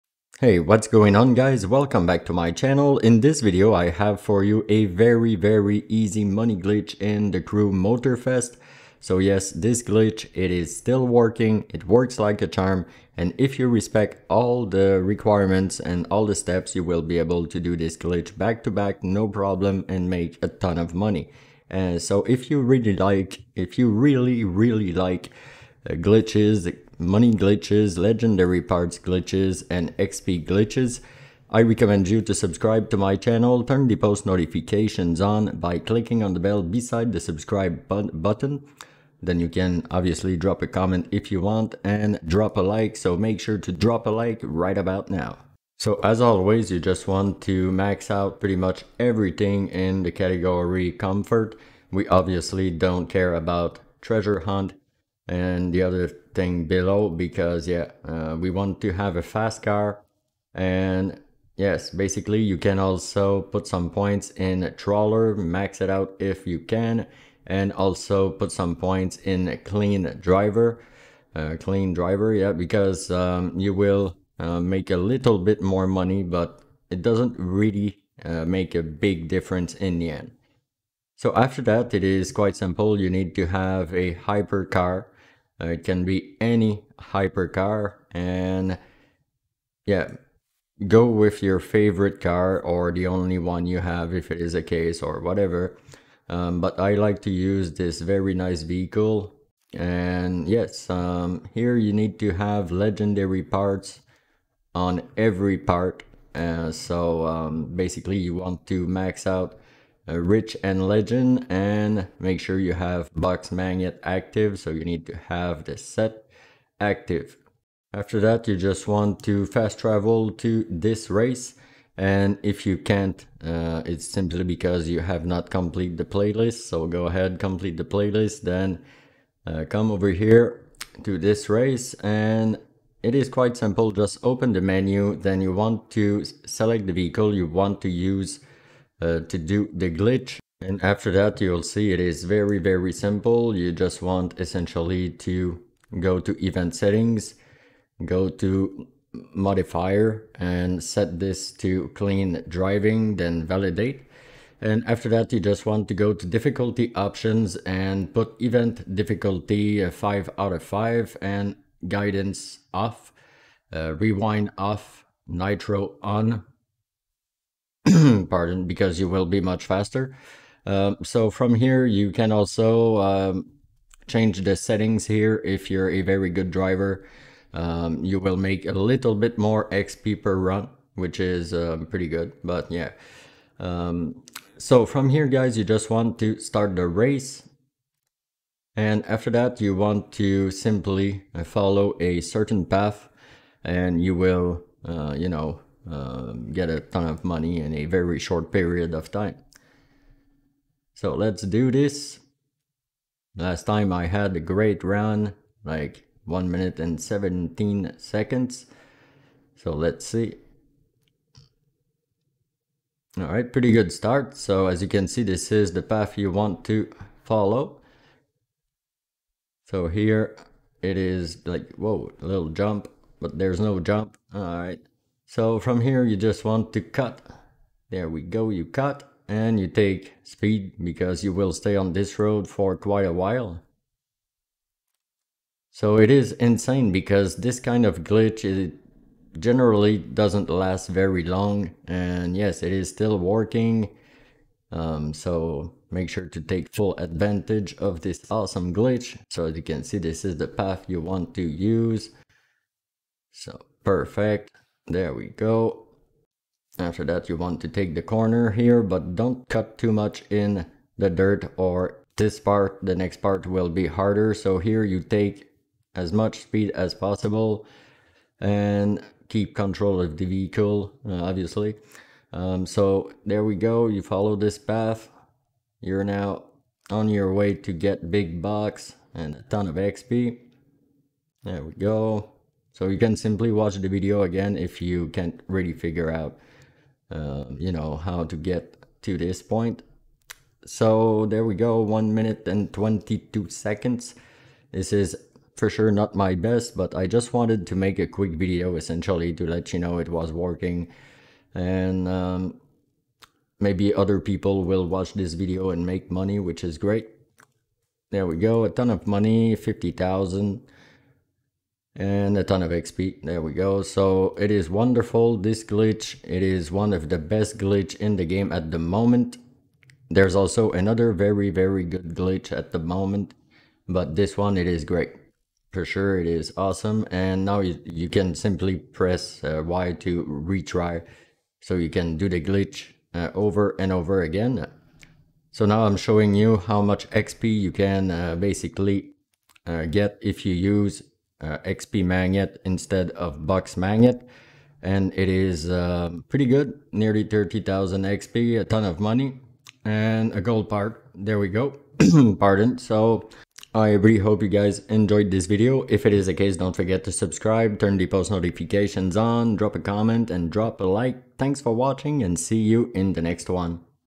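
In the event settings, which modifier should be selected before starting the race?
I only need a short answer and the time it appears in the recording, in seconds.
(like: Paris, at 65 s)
Clean driving, at 151 s.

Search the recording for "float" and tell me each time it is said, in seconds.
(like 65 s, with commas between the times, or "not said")
not said.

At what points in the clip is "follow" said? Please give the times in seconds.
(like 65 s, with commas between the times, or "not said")
191 s, 217 s, 274 s.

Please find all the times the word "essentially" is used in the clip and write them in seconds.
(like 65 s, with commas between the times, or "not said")
144 s, 298 s.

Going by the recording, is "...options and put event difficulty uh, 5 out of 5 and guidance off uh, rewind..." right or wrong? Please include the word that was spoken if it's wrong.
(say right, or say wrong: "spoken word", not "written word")
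right.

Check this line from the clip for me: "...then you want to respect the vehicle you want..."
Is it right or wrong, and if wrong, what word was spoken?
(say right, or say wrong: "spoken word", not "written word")
wrong: "select", not "respect".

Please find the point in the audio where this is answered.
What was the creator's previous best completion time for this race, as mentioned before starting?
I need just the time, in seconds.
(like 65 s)
206 s.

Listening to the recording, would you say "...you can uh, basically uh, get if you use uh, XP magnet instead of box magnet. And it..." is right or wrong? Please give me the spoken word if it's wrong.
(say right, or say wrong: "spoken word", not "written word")
right.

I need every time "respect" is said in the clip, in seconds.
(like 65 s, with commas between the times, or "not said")
13 s.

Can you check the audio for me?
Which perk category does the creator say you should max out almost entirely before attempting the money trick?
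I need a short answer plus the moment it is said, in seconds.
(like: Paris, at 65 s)
Comfort, at 50 s.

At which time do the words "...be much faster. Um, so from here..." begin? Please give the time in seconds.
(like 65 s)
169 s.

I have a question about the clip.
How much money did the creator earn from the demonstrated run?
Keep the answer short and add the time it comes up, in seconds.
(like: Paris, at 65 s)
50,000, at 309 s.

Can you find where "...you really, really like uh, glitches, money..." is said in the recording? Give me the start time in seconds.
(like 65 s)
23 s.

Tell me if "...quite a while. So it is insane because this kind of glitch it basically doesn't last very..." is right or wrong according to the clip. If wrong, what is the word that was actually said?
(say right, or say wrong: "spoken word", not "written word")
wrong: "generally", not "basically".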